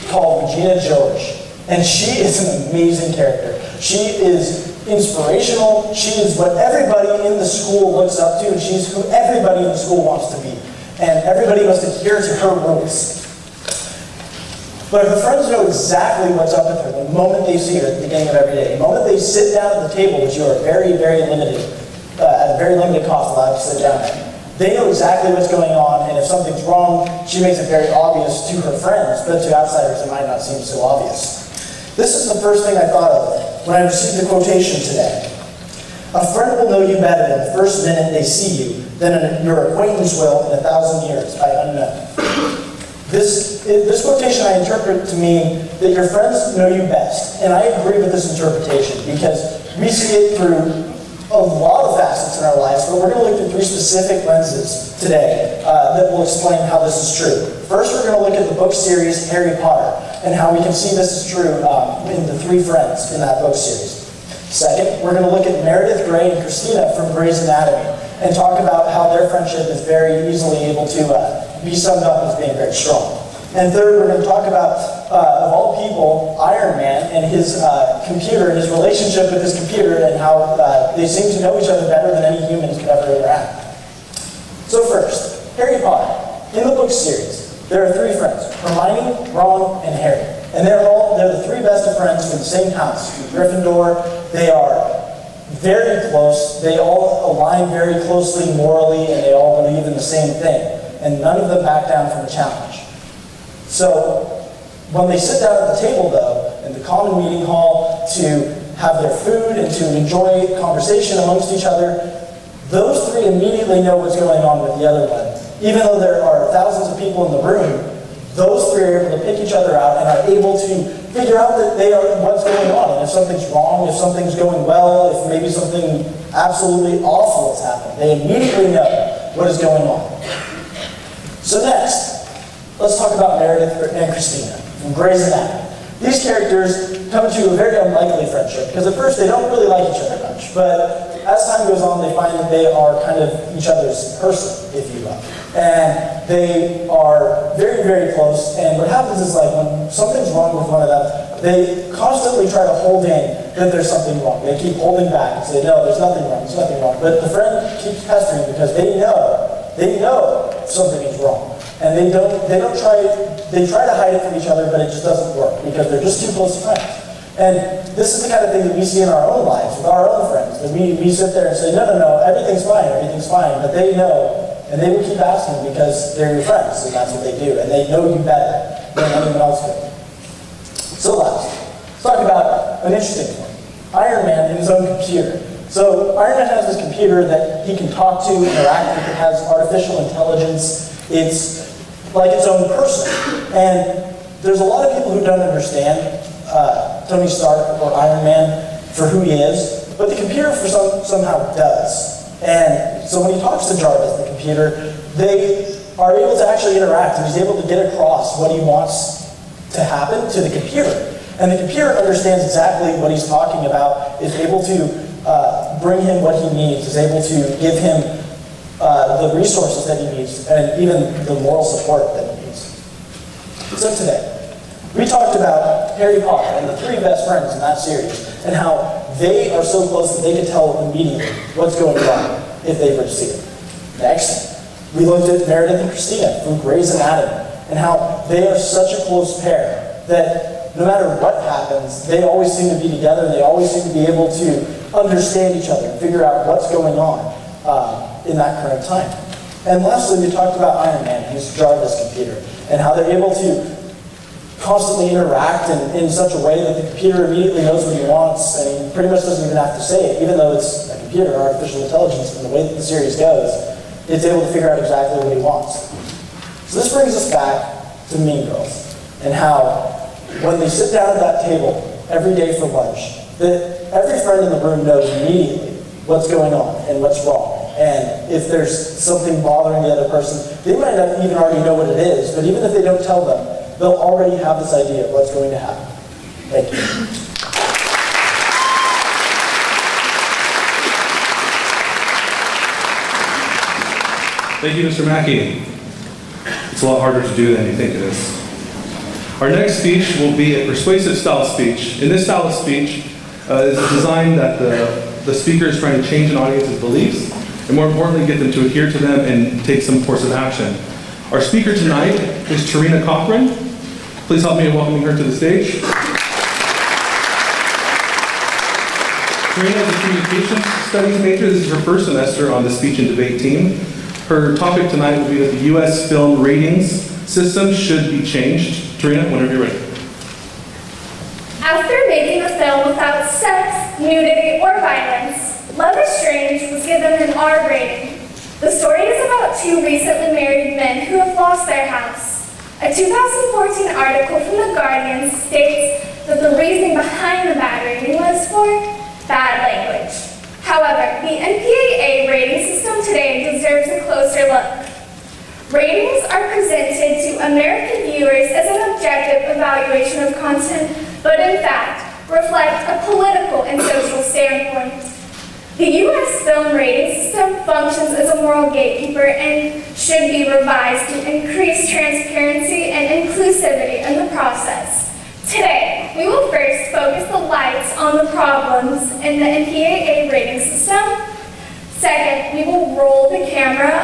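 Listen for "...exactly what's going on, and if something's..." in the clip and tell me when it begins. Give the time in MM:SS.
00:24.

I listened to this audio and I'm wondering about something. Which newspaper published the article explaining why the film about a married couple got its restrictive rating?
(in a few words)
The Guardian.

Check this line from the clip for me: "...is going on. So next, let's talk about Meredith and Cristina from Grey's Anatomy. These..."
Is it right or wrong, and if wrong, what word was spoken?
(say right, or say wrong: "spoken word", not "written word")
right.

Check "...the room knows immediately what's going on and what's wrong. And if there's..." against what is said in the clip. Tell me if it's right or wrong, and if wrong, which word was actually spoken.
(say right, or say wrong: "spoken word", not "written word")
right.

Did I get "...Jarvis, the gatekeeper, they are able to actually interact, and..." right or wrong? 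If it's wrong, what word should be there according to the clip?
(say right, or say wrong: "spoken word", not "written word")
wrong: "computer", not "gatekeeper".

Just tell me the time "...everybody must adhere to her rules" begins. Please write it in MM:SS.
00:11.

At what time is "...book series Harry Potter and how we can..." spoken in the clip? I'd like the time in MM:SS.
00:58.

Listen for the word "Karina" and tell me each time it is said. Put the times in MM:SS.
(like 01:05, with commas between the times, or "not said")
05:19, 05:28.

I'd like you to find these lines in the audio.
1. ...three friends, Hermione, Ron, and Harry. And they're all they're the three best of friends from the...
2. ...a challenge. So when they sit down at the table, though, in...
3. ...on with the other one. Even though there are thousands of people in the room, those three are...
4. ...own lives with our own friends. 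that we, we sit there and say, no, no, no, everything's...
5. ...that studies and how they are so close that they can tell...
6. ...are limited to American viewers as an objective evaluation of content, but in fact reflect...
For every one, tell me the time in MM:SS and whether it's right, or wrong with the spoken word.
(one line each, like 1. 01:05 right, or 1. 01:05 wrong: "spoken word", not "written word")
1. 01:27 right
2. 01:42 right
3. 01:54 right
4. 02:49 right
5. 03:47 wrong: "series", not "studies"
6. 05:56 wrong: "presented", not "limited".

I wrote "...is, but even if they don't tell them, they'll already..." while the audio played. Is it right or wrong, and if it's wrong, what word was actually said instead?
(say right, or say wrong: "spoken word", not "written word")
right.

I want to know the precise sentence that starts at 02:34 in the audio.
They keep holding back and say, no, there's nothing wrong, there's nothing wrong.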